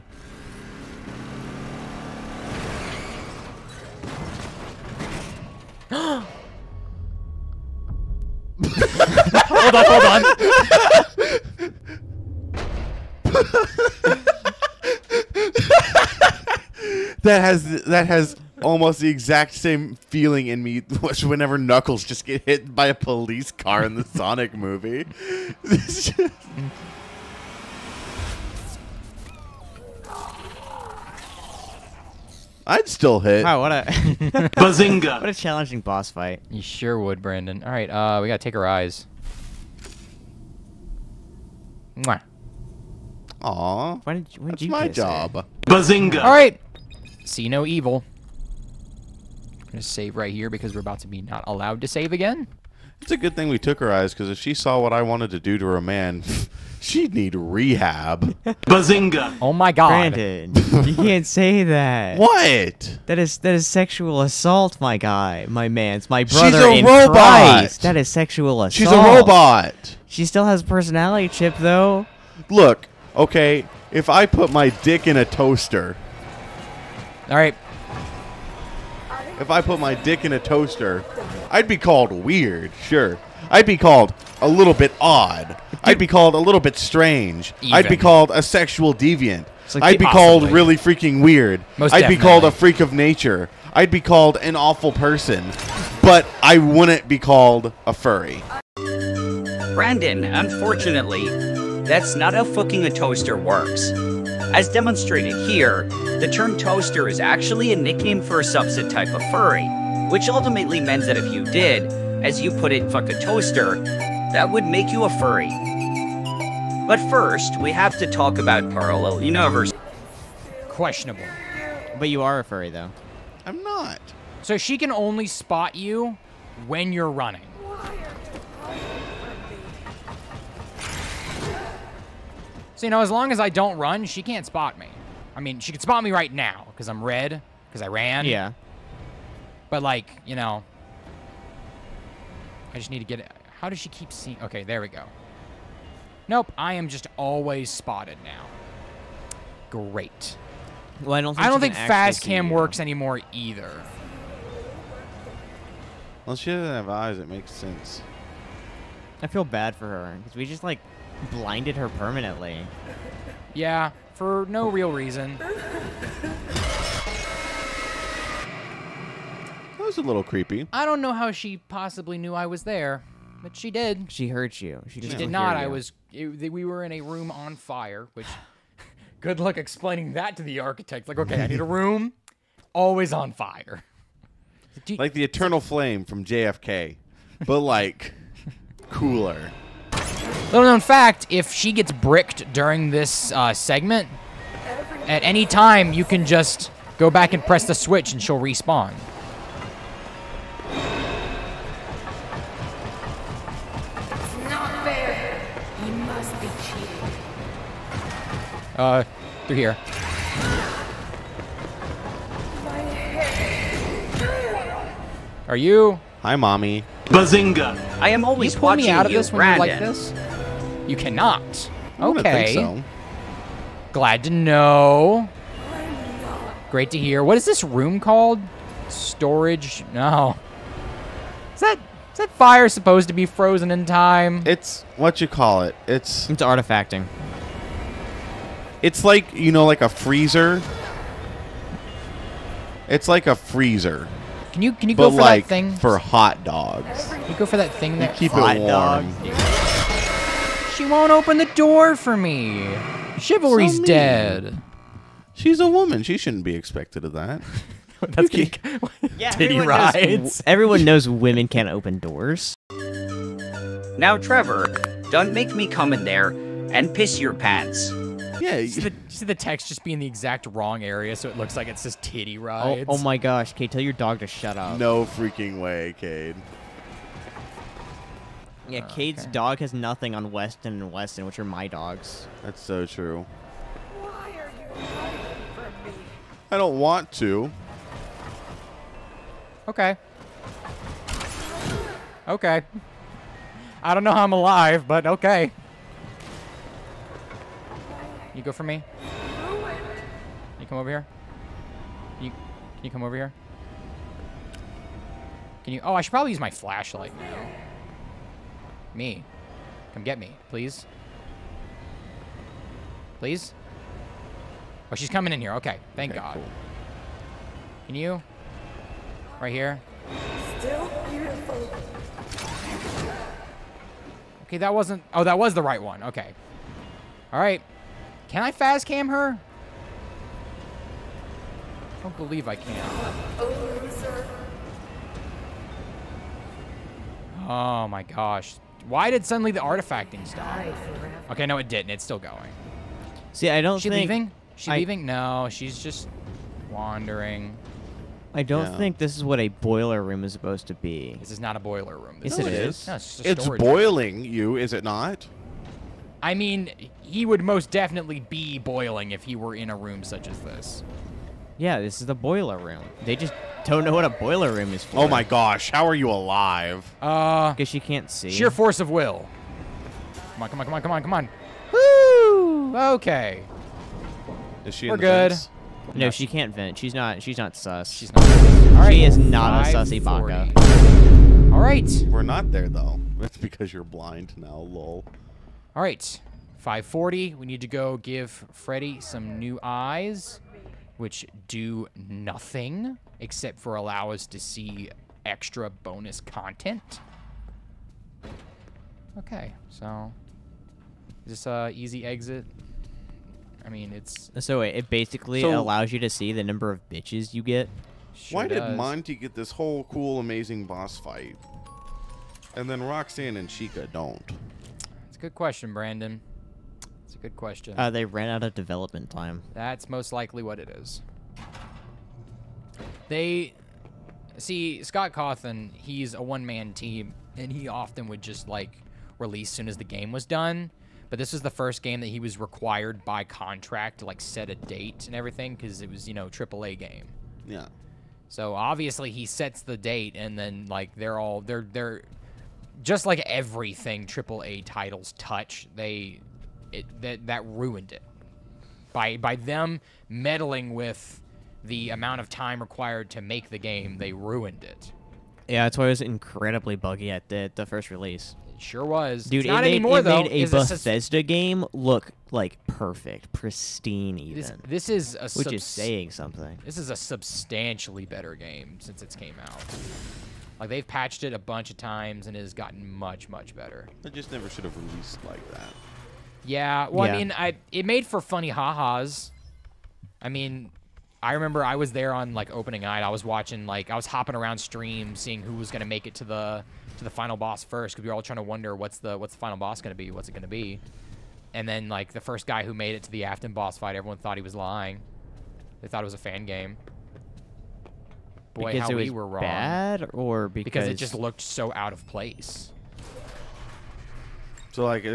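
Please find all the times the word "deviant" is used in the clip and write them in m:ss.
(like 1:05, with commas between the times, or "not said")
1:28.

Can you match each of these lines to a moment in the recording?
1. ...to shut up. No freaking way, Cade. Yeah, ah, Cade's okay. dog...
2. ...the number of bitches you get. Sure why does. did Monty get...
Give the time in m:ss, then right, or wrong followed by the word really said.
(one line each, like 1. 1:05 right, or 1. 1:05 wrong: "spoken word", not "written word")
1. 4:34 wrong: "Kate", not "Cade"
2. 6:46 right.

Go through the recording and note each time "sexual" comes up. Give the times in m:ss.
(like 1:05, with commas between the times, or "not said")
1:03, 1:08, 1:28.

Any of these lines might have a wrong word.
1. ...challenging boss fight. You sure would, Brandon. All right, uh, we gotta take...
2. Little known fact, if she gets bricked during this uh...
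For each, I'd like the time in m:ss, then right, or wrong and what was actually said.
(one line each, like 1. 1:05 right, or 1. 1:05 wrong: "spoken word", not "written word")
1. 0:35 right
2. 3:10 right.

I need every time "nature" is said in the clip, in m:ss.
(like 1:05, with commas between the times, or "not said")
1:32.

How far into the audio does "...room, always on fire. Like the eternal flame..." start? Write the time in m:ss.
3:01.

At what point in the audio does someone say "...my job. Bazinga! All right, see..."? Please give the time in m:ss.
0:44.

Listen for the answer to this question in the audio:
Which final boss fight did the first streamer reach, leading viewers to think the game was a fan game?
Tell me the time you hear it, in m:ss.
8:13.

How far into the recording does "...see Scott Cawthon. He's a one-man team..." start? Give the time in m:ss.
7:04.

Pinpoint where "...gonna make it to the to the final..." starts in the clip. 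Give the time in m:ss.
8:05.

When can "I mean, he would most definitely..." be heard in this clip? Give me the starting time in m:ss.
5:56.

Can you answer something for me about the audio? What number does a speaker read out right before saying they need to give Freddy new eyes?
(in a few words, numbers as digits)
540.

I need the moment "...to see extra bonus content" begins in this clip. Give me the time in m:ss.
6:34.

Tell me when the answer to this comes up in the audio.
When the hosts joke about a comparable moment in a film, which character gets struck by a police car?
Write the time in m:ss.
0:21.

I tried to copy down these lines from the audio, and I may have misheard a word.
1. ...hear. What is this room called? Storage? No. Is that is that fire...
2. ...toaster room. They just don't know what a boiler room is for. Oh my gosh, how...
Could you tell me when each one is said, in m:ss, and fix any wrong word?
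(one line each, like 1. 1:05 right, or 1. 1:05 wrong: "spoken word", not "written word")
1. 3:46 right
2. 6:02 wrong: "boiler", not "toaster".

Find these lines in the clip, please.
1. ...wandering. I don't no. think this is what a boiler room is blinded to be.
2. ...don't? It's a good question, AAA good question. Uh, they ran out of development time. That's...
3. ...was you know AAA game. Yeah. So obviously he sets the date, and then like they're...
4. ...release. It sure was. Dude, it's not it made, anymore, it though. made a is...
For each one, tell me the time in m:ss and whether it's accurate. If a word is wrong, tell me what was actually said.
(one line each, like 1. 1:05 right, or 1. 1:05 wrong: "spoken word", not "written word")
1. 5:46 wrong: "supposed", not "blinded"
2. 6:53 wrong: "Brandon", not "AAA"
3. 7:15 right
4. 7:37 right.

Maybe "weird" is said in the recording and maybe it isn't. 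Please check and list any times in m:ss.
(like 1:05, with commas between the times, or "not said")
1:22, 1:31.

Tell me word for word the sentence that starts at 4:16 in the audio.
She shouldn't be expected of that.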